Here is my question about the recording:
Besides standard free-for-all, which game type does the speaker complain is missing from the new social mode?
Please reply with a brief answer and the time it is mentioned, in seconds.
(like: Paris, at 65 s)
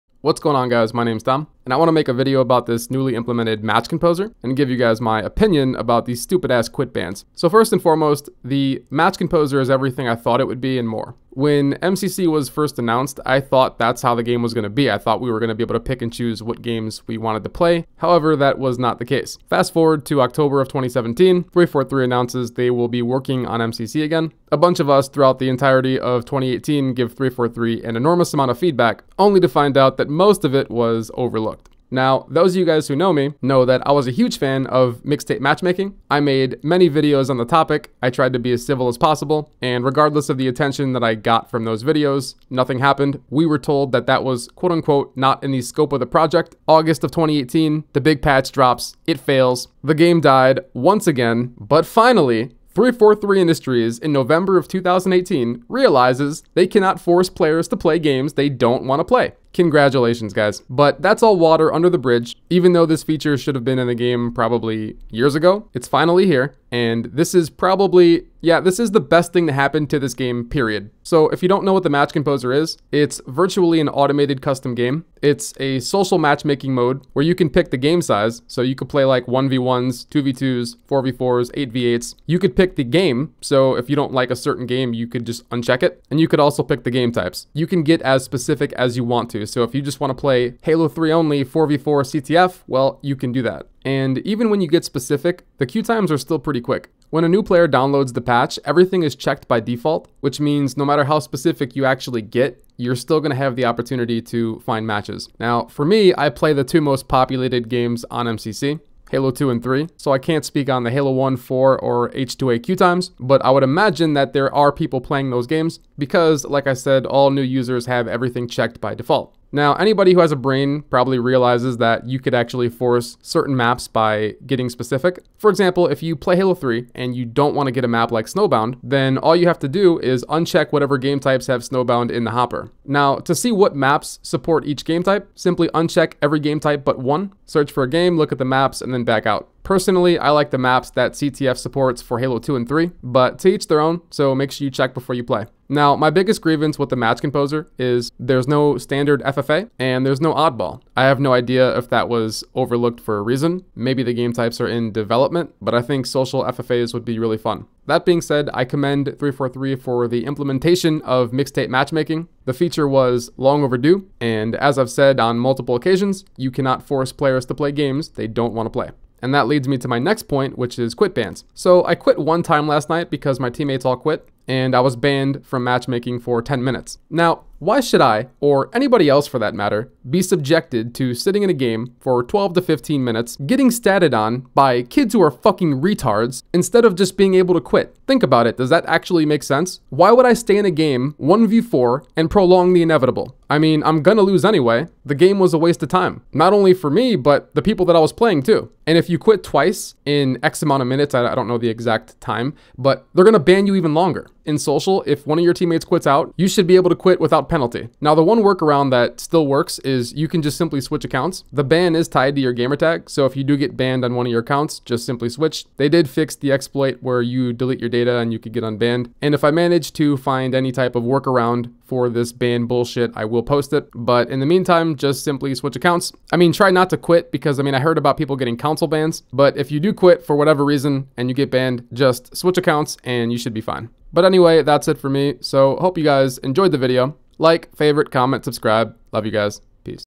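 Oddball, at 150 s.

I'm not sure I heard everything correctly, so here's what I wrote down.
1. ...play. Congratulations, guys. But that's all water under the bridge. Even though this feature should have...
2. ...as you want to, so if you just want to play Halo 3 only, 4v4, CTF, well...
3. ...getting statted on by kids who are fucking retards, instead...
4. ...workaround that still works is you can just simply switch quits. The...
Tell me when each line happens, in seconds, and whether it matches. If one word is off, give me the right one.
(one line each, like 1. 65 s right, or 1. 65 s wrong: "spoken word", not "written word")
1. 59 s right
2. 88 s right
3. 183 s right
4. 208 s wrong: "accounts", not "quits".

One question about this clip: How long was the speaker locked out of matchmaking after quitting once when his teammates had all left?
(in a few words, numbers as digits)
10 minutes.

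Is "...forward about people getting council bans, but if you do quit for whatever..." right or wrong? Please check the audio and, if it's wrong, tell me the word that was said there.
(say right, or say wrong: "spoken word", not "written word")
wrong: "heard", not "forward".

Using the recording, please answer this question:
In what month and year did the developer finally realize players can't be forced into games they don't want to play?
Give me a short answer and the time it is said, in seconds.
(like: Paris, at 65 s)
November 2018, at 54 s.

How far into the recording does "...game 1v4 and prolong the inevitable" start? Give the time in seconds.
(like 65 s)
190 s.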